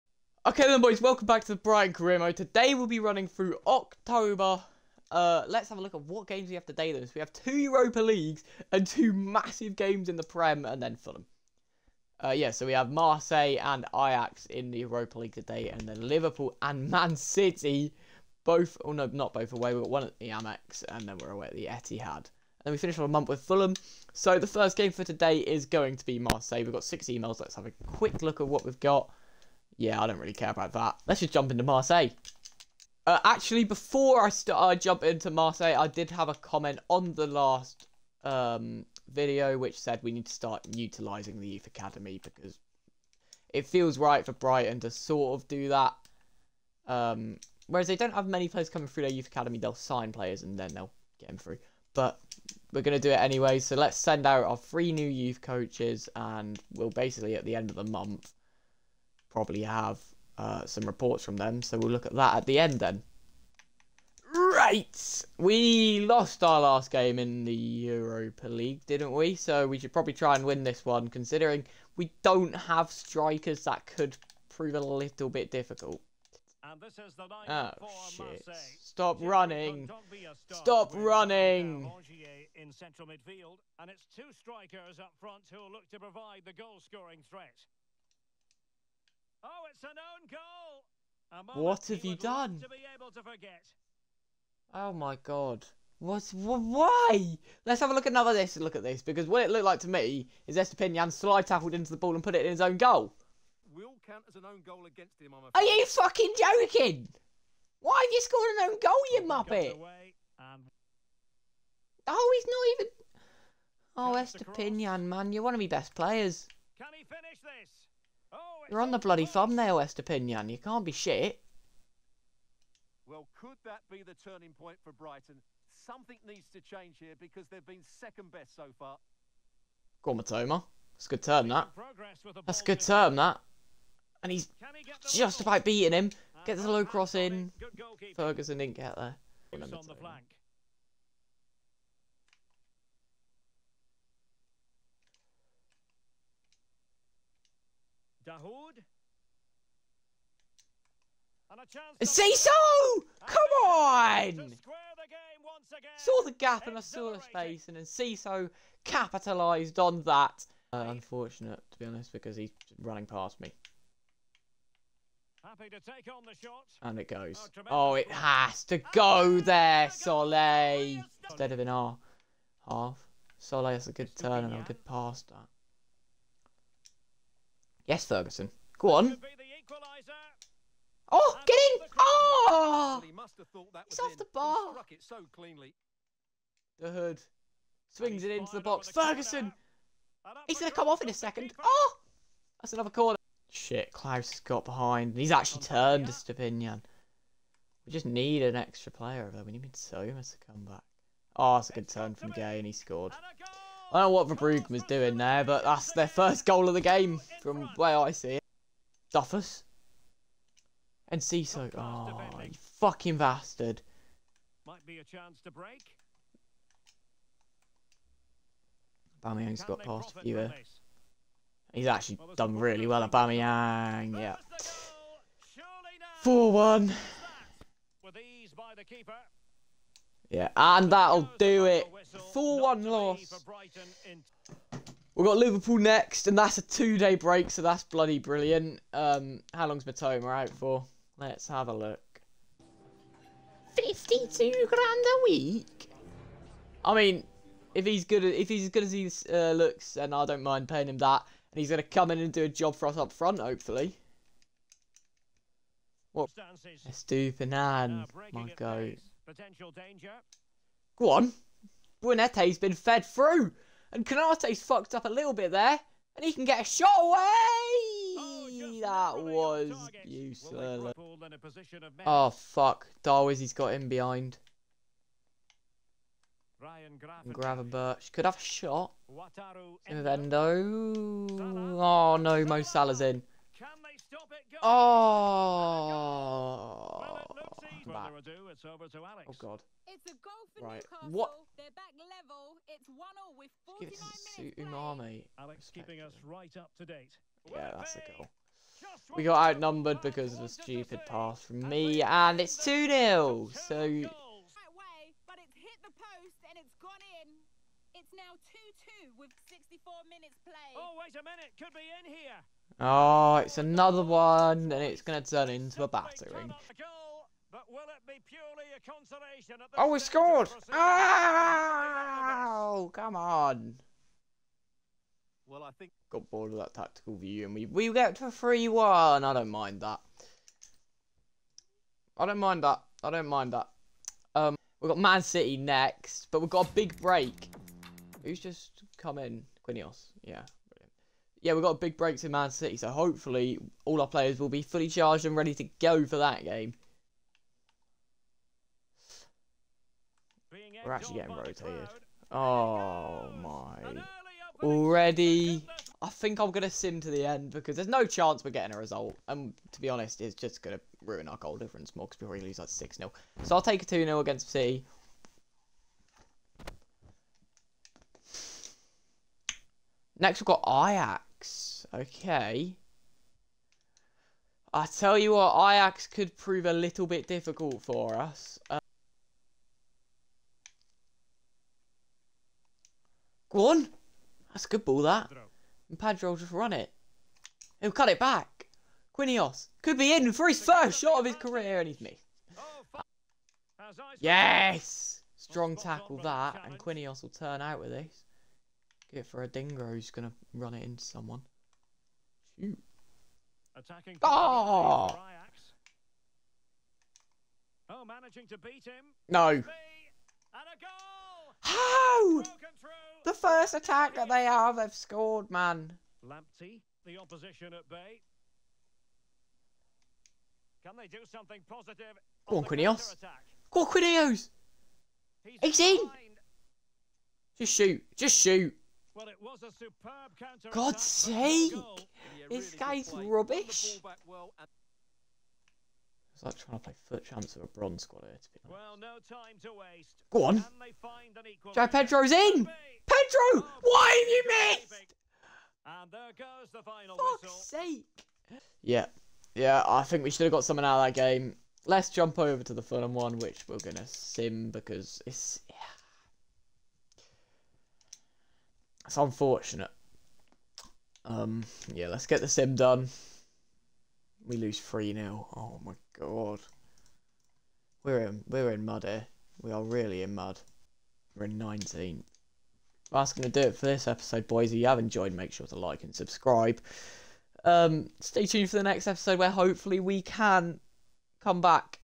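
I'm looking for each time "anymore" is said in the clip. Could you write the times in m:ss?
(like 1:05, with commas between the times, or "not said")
not said.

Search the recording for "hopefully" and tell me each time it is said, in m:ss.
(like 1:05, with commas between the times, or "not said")
4:13, 5:42, 7:59.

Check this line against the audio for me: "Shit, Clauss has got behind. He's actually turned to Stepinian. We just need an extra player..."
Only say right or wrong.
right.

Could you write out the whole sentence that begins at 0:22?
And then we finish on a month with Fulham.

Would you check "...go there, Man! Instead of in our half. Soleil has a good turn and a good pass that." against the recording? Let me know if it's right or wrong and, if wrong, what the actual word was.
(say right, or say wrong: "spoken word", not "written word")
wrong: "Soleil", not "Man".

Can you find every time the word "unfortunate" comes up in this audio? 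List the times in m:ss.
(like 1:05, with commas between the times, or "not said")
2:40, 7:39.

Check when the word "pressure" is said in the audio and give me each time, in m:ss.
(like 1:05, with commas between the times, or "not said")
not said.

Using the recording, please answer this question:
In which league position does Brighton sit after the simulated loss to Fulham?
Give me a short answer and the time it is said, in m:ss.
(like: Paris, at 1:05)
19th, at 7:51.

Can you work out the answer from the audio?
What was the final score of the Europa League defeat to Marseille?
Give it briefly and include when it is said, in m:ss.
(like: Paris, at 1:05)
4-1, at 3:52.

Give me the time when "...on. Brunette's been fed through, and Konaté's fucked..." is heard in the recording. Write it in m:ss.
4:21.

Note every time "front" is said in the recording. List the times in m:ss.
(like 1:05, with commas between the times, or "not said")
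1:25, 4:13.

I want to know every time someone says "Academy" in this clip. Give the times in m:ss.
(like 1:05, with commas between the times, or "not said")
0:41, 0:49.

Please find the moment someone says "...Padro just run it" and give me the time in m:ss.
6:25.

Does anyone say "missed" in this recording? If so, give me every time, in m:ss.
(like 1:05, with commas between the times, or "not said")
6:32, 7:24.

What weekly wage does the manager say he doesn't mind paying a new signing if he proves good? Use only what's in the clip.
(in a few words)
52 grand a week.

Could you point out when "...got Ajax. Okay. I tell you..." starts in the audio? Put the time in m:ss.
6:10.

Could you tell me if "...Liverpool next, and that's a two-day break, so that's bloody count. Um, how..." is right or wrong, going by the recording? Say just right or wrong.
wrong.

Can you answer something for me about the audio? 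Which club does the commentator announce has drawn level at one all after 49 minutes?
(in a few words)
Newcastle.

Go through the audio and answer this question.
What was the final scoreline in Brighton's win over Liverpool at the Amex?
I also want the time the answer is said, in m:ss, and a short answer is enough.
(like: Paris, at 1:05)
3-1, at 5:28.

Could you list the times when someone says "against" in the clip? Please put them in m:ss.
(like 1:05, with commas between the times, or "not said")
1:44, 6:04.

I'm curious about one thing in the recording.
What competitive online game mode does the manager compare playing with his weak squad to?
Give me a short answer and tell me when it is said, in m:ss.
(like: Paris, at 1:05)
FUT Champs, at 7:17.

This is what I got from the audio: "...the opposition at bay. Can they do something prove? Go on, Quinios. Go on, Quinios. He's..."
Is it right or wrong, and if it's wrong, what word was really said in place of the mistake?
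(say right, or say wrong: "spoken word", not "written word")
wrong: "positive", not "prove".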